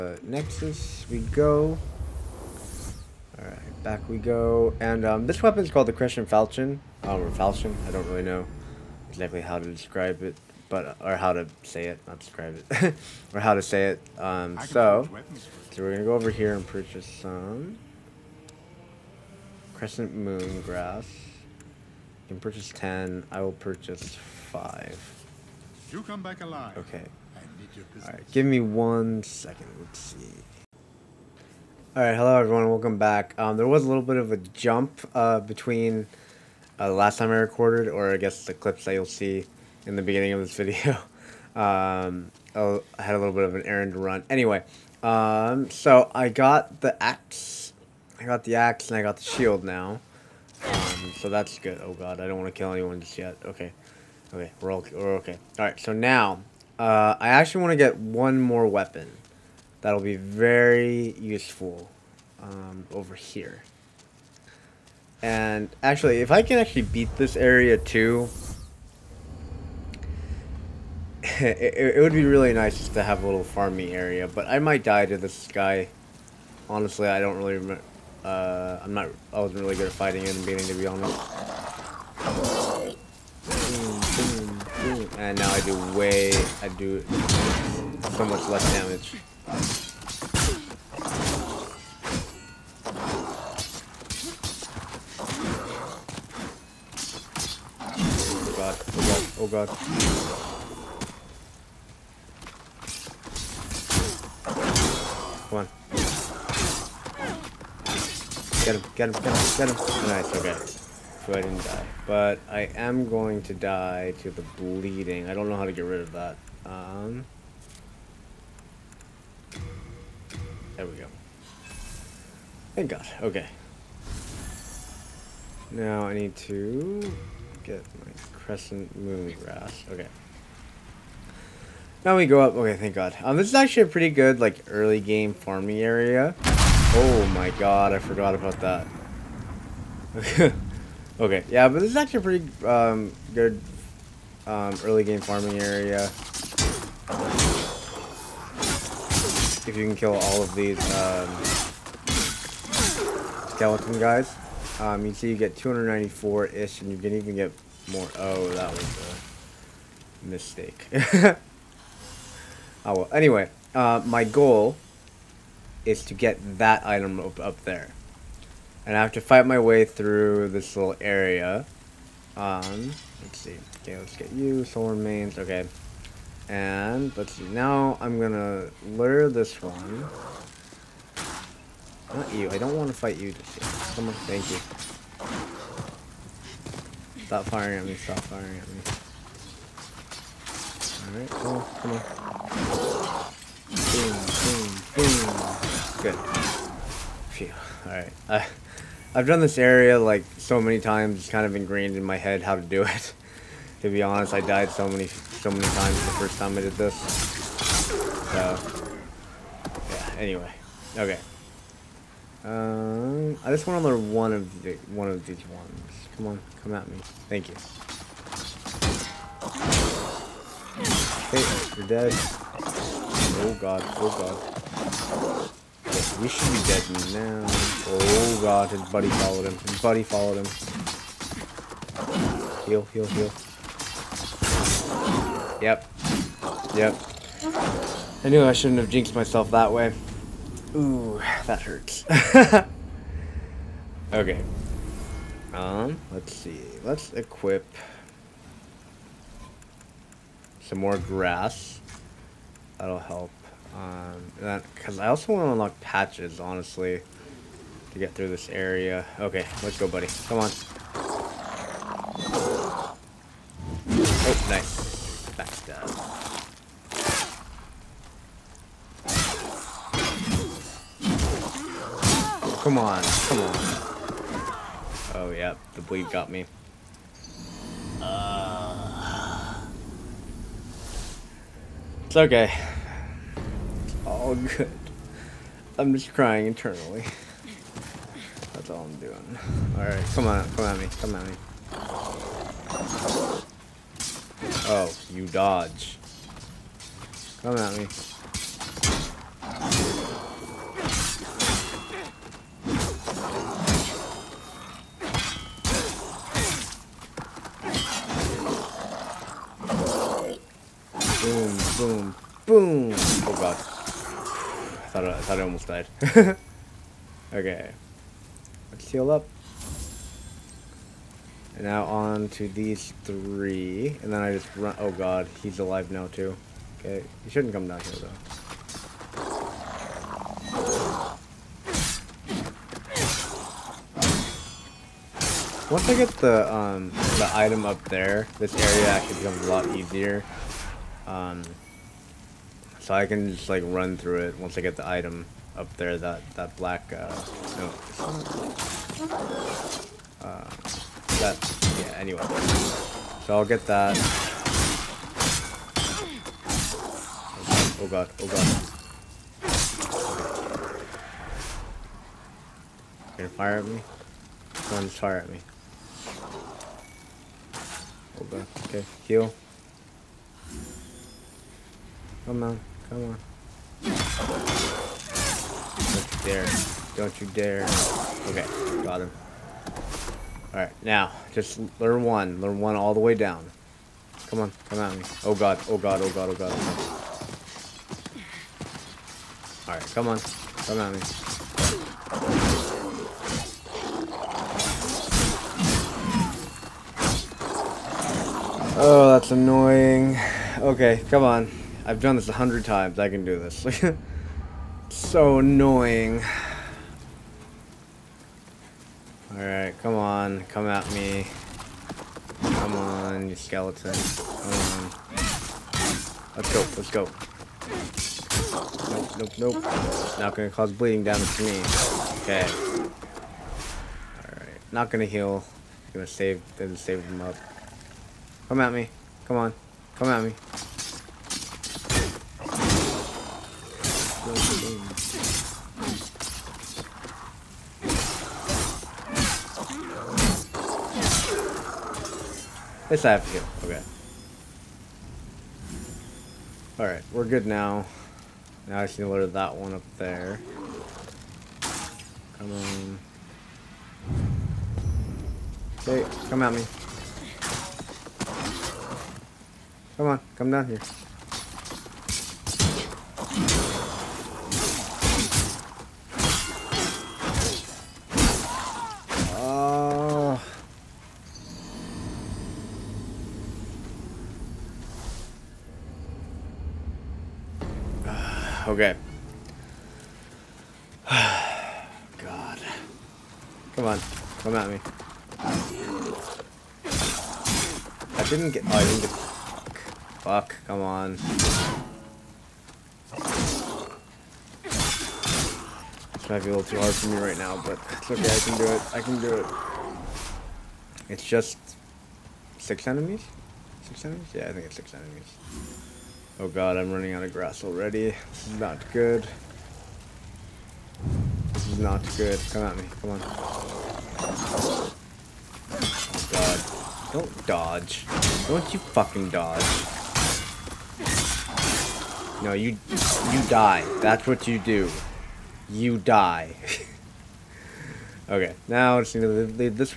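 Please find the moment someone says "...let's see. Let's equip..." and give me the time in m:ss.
4:06.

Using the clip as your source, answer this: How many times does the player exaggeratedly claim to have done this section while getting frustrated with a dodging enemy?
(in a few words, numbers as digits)
100.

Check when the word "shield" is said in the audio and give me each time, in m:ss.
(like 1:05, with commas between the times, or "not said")
0:49.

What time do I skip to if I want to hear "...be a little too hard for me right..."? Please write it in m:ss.
8:16.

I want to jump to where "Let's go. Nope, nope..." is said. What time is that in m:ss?
6:56.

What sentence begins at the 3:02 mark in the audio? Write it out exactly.
Not you, I don't want to fight you just yet.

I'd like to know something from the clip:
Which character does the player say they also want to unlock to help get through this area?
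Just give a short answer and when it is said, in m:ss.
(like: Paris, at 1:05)
Patches, at 4:15.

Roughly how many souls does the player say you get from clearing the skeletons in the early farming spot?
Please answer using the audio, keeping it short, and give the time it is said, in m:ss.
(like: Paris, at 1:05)
294, at 2:35.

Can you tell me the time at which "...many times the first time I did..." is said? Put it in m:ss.
3:25.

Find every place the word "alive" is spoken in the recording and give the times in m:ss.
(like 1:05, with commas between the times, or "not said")
0:26, 5:25.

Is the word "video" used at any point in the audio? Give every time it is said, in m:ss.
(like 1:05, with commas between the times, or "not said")
0:40.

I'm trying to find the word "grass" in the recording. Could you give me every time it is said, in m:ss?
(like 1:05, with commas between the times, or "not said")
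0:20, 2:09, 4:10, 8:27.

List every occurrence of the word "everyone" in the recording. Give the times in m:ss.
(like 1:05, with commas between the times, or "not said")
0:32.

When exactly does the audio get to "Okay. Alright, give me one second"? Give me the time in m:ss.
0:26.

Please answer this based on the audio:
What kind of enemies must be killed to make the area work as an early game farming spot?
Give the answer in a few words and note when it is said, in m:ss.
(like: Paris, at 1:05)
skeleton guys, at 2:33.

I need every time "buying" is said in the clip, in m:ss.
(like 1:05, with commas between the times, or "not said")
not said.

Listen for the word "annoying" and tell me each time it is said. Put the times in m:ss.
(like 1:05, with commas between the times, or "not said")
6:39, 6:45.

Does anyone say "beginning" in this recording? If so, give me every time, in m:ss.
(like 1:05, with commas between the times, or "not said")
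0:40, 1:20.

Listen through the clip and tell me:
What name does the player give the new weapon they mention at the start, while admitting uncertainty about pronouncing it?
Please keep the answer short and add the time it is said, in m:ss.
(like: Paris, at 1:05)
Crescent Falchion, at 0:05.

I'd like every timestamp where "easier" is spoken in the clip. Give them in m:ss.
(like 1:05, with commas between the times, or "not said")
5:39.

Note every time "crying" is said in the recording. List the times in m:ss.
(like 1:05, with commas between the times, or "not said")
4:46.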